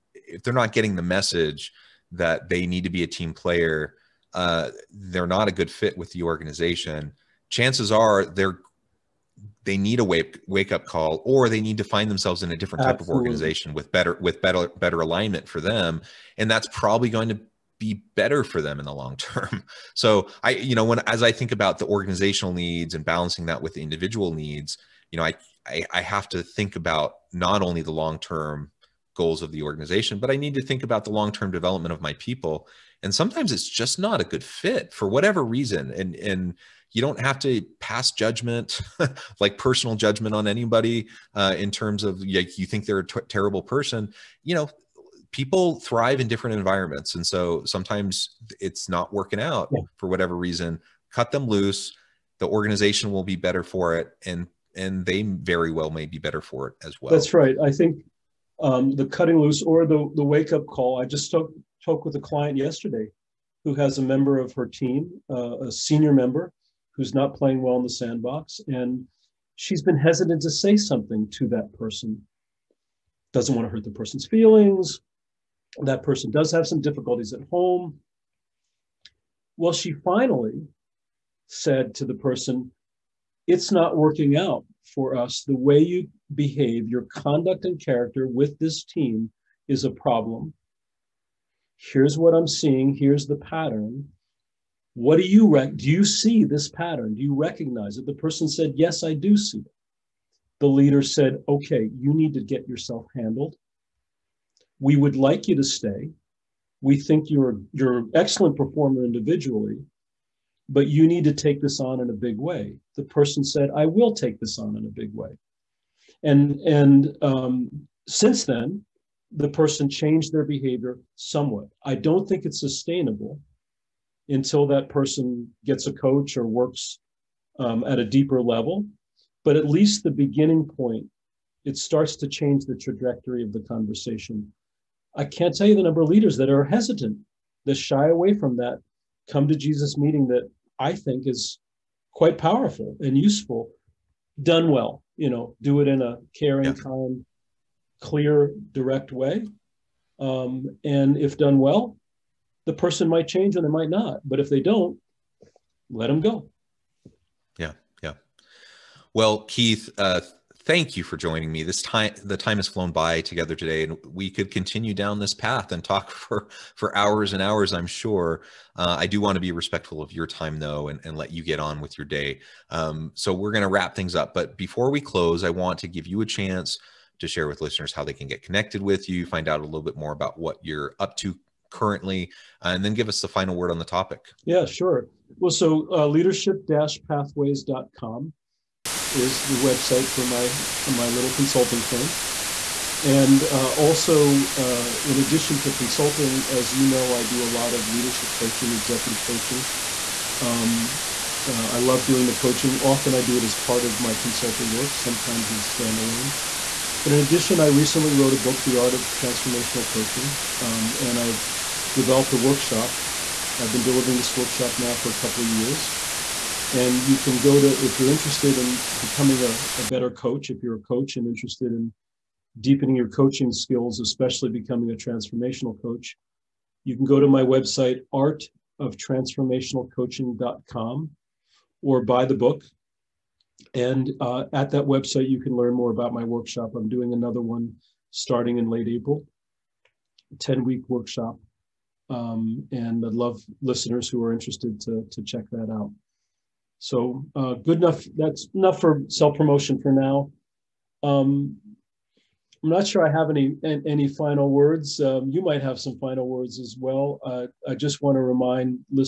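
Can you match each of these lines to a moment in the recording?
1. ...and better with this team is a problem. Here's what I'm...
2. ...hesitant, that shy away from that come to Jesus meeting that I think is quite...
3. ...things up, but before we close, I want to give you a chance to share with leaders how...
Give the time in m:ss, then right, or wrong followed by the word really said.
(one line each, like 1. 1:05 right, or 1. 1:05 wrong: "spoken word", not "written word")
1. 1:27 wrong: "character", not "better"
2. 2:16 right
3. 2:53 wrong: "listeners", not "leaders".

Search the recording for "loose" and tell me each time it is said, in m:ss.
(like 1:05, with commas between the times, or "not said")
0:51, 0:59.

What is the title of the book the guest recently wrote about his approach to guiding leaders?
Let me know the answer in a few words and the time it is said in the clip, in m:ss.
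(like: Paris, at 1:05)
The Art of Transformational Coaching, at 3:28.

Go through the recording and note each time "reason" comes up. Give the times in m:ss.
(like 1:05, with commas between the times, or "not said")
0:35, 0:50.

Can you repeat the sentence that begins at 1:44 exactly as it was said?
We would like you to stay.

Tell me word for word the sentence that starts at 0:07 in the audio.
Chances are they're they need a wake wake up call, or they need to find themselves in a different Absolutely.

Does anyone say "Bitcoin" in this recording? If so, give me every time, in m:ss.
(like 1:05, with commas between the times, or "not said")
not said.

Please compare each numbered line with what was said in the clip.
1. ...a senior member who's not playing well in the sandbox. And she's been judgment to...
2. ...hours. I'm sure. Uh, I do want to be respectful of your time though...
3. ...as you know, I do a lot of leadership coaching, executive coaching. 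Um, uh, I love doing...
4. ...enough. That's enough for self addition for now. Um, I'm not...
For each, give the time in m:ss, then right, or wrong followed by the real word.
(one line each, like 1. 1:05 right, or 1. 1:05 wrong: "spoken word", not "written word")
1. 1:05 wrong: "hesitant", not "judgment"
2. 2:47 right
3. 3:16 right
4. 4:07 wrong: "promotion", not "addition".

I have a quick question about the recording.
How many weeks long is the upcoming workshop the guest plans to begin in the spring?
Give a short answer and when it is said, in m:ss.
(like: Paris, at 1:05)
10, at 4:00.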